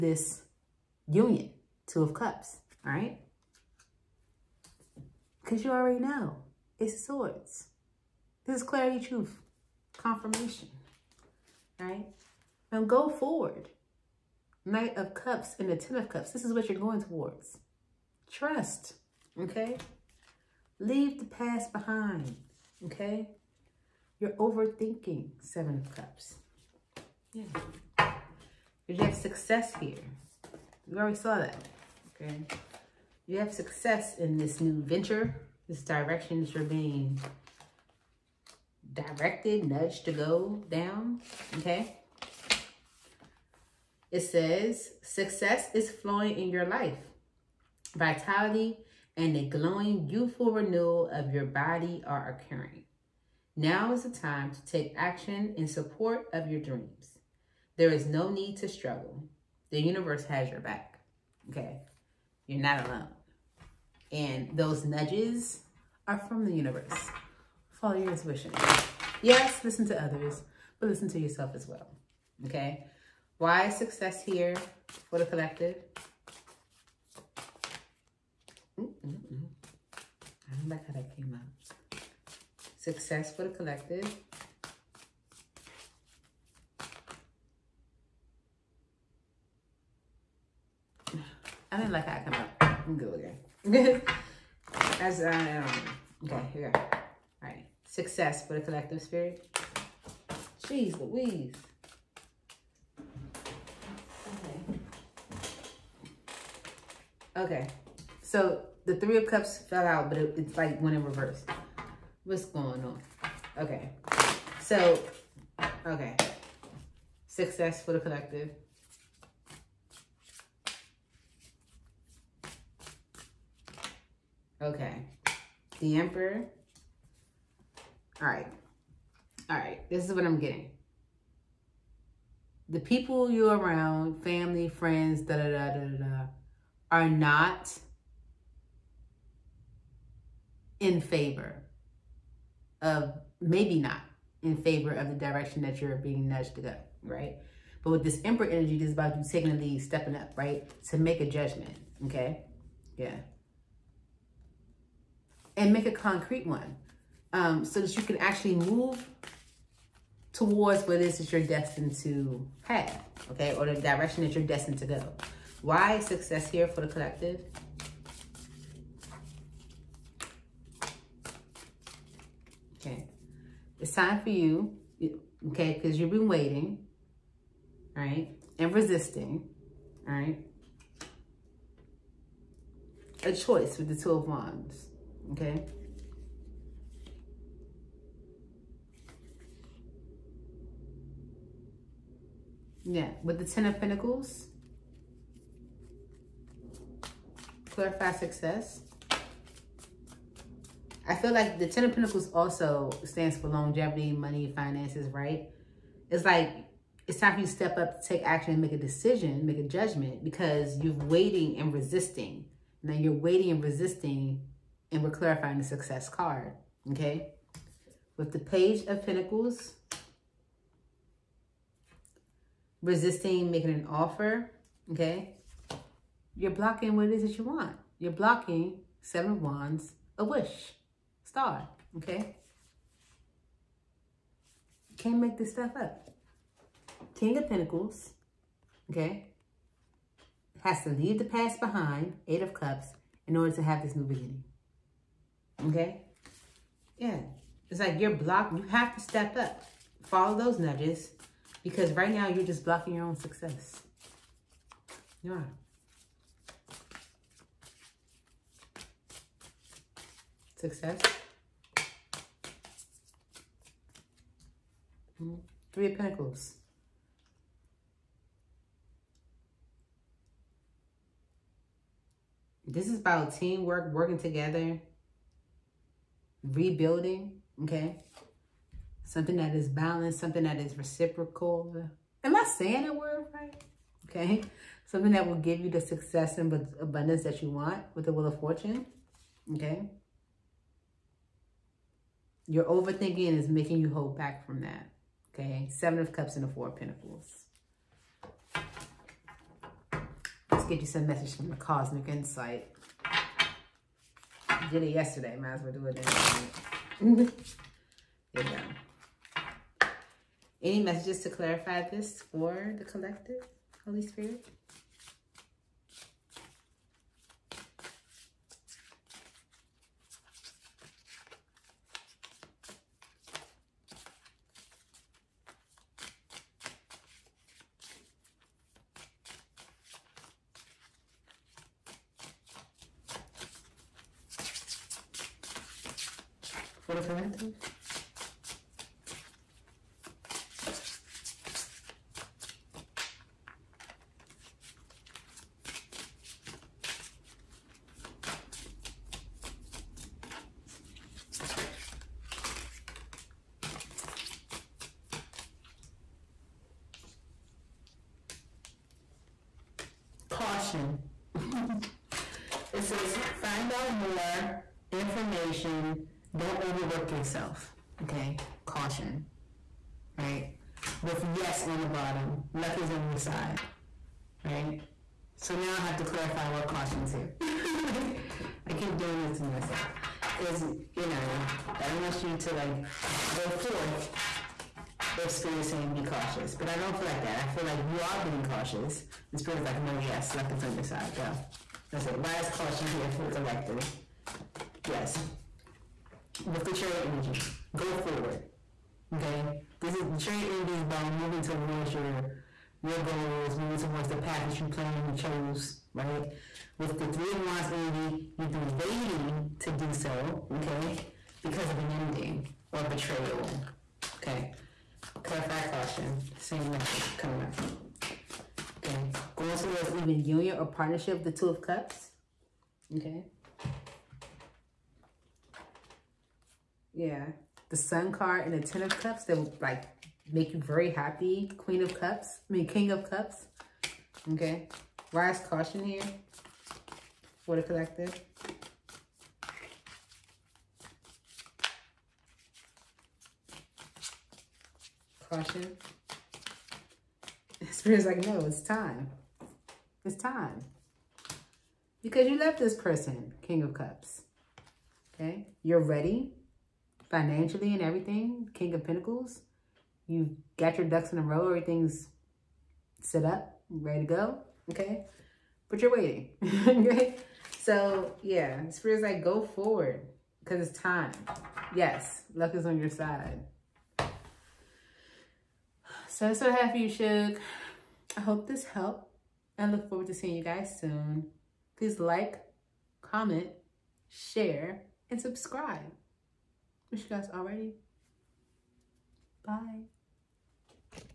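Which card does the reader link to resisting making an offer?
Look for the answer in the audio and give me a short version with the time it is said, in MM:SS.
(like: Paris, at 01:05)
Page of Pentacles, at 03:38.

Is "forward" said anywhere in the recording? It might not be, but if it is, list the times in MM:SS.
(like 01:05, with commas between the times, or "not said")
00:13, 06:37, 07:49, 07:59.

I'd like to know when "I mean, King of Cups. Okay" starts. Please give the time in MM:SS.
07:12.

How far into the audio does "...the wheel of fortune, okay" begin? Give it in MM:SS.
04:48.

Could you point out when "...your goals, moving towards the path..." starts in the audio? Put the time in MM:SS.
06:42.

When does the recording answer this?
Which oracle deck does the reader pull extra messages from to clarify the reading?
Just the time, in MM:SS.
05:01.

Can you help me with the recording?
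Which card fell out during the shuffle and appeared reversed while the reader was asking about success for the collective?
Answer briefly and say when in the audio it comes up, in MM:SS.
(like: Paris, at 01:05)
Three of Cups, at 01:48.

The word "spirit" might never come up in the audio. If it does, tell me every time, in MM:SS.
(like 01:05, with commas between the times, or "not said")
01:39, 05:14, 06:25, 06:29, 07:27, 07:48.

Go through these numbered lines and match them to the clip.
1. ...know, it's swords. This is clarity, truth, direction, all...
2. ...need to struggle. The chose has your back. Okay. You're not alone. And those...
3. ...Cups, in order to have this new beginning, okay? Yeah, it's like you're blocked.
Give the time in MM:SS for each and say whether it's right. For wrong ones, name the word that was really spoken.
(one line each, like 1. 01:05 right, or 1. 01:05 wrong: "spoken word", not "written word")
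1. 00:05 wrong: "confirmation", not "direction"
2. 00:58 wrong: "universe", not "chose"
3. 04:02 right.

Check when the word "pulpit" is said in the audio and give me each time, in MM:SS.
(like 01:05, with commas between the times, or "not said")
not said.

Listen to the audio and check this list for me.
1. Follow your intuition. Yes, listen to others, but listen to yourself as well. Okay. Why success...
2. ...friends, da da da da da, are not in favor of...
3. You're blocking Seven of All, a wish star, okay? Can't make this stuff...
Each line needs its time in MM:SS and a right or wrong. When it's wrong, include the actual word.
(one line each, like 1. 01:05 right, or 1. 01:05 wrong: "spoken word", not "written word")
1. 01:07 right
2. 02:14 right
3. 03:47 wrong: "Wands", not "All".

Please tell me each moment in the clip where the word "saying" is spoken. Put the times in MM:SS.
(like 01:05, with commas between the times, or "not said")
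04:42, 06:25.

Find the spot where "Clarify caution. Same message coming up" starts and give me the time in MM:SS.
06:55.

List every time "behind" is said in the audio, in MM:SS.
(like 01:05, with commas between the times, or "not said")
00:21, 04:01.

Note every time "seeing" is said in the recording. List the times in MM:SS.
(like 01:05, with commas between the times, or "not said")
08:00.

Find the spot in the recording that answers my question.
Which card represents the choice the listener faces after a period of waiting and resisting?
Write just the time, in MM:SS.
03:03.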